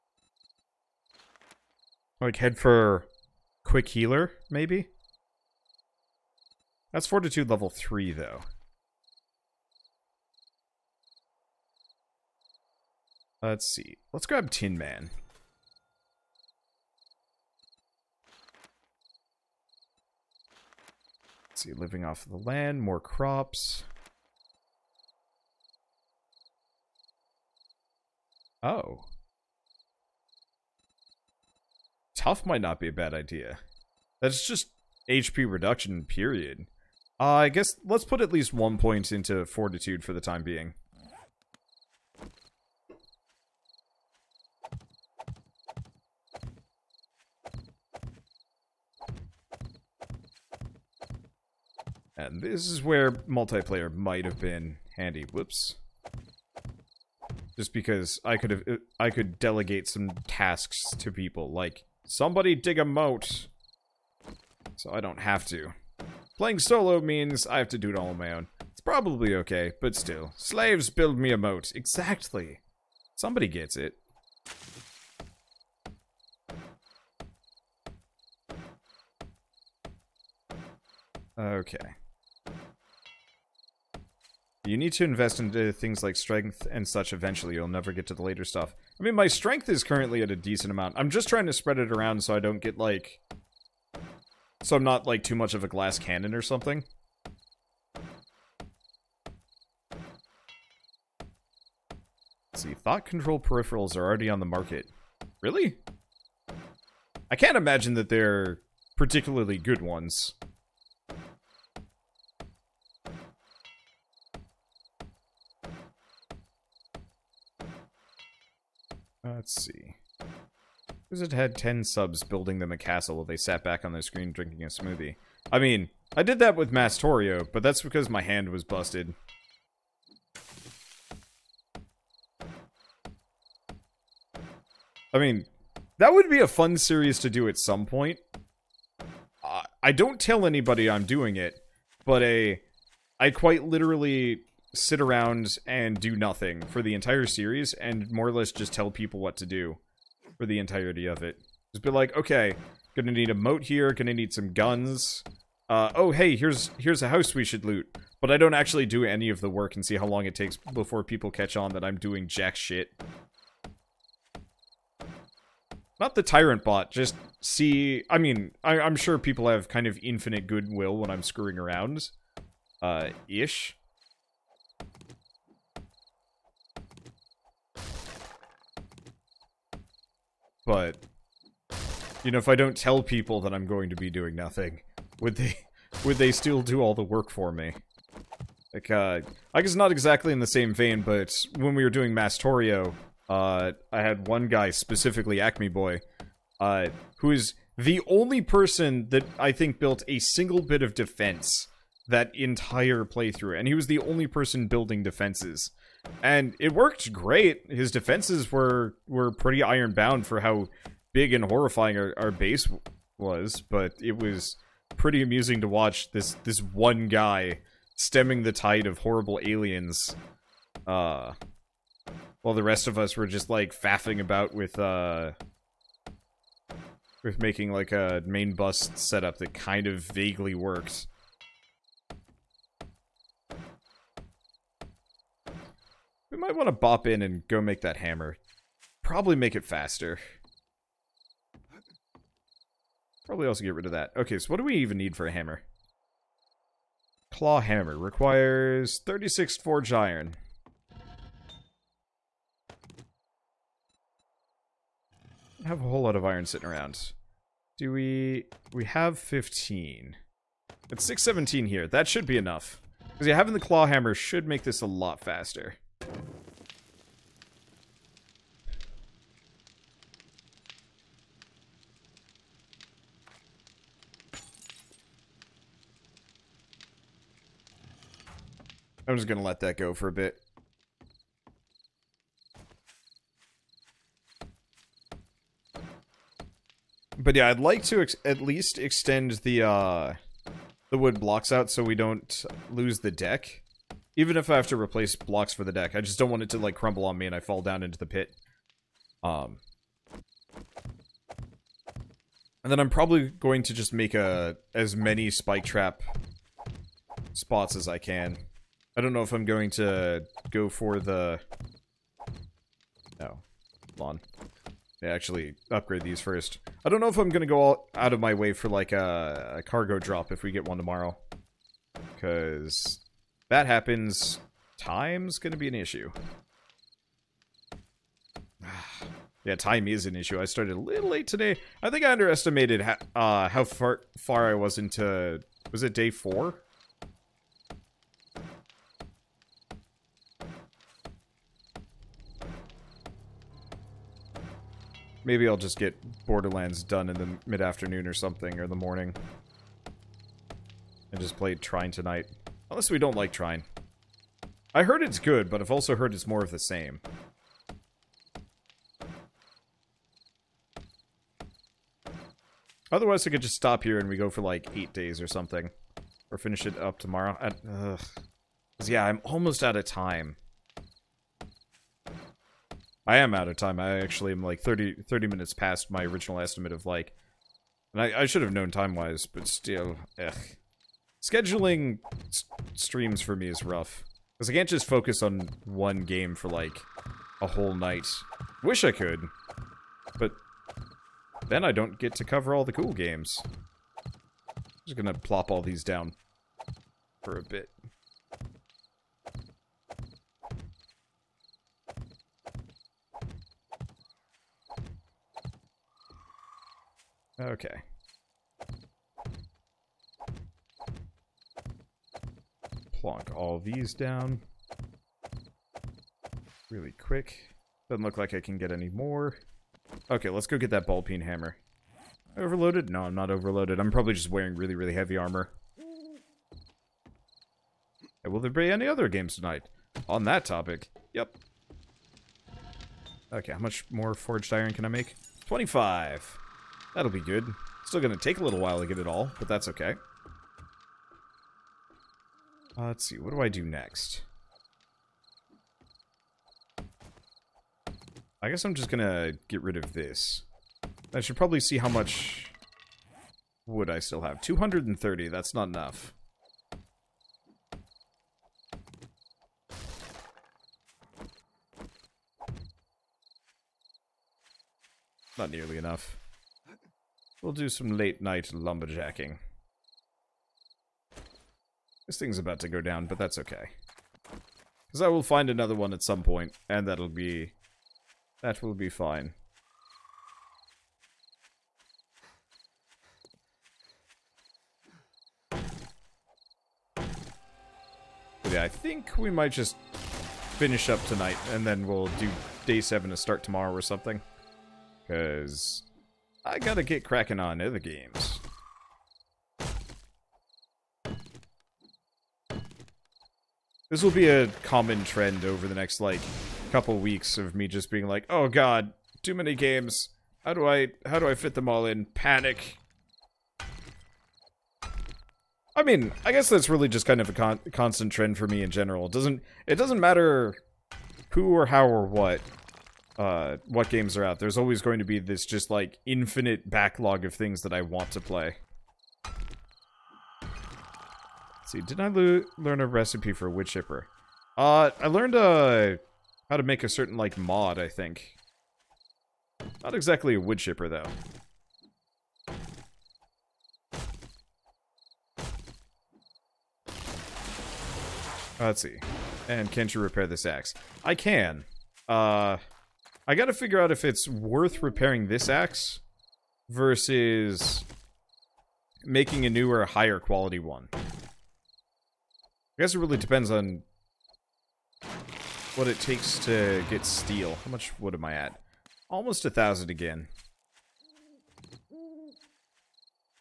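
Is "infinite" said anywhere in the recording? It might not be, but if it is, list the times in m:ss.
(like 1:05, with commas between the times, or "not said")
2:50, 8:46.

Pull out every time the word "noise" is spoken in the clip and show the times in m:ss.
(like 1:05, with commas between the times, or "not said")
not said.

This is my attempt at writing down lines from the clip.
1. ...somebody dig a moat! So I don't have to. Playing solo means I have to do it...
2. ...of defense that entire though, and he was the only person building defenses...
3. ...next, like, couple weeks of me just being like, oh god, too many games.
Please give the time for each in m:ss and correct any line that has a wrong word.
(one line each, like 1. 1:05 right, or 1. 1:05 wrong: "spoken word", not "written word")
1. 1:02 right
2. 3:20 wrong: "playthrough", not "though"
3. 8:25 right.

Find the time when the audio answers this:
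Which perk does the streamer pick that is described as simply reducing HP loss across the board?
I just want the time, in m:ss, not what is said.
0:32.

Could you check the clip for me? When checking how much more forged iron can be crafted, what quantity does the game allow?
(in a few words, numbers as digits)
25.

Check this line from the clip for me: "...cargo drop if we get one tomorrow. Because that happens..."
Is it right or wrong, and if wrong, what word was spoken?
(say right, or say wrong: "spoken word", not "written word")
right.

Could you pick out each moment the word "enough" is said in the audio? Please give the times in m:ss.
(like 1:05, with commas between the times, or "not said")
4:22, 7:35, 7:45.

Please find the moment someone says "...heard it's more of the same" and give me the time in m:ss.
5:55.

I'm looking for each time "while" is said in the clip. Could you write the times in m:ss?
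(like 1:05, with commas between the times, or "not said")
2:03, 3:42, 7:18.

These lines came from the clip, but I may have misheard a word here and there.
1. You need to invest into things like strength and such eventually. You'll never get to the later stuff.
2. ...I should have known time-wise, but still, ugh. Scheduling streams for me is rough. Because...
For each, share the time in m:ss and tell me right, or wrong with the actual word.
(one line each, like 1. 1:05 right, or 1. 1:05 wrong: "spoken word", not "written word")
1. 1:24 right
2. 6:18 right.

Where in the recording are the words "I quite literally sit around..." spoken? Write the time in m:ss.
2:23.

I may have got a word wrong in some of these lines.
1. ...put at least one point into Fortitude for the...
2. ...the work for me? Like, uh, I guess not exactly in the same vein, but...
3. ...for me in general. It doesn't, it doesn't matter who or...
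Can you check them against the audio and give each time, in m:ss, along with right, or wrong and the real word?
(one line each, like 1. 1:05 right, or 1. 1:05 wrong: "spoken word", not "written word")
1. 0:38 right
2. 3:06 right
3. 8:38 right.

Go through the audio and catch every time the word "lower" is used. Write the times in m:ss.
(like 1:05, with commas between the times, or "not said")
not said.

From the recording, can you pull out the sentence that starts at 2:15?
I mean, that would be a fun series to do at some point.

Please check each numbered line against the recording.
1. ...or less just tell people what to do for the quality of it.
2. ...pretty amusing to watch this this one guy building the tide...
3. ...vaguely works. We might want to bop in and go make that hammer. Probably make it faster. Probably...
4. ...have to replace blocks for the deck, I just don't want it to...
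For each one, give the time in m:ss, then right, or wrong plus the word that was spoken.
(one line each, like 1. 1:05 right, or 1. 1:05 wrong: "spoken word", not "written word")
1. 2:28 wrong: "entirety", not "quality"
2. 3:34 wrong: "stemming", not "building"
3. 3:50 right
4. 4:54 right.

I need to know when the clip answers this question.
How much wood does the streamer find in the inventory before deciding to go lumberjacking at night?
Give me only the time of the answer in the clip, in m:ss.
7:34.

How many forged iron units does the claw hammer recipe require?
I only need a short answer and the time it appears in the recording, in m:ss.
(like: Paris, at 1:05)
36, at 4:09.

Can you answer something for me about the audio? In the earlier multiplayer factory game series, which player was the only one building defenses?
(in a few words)
Acme Boy.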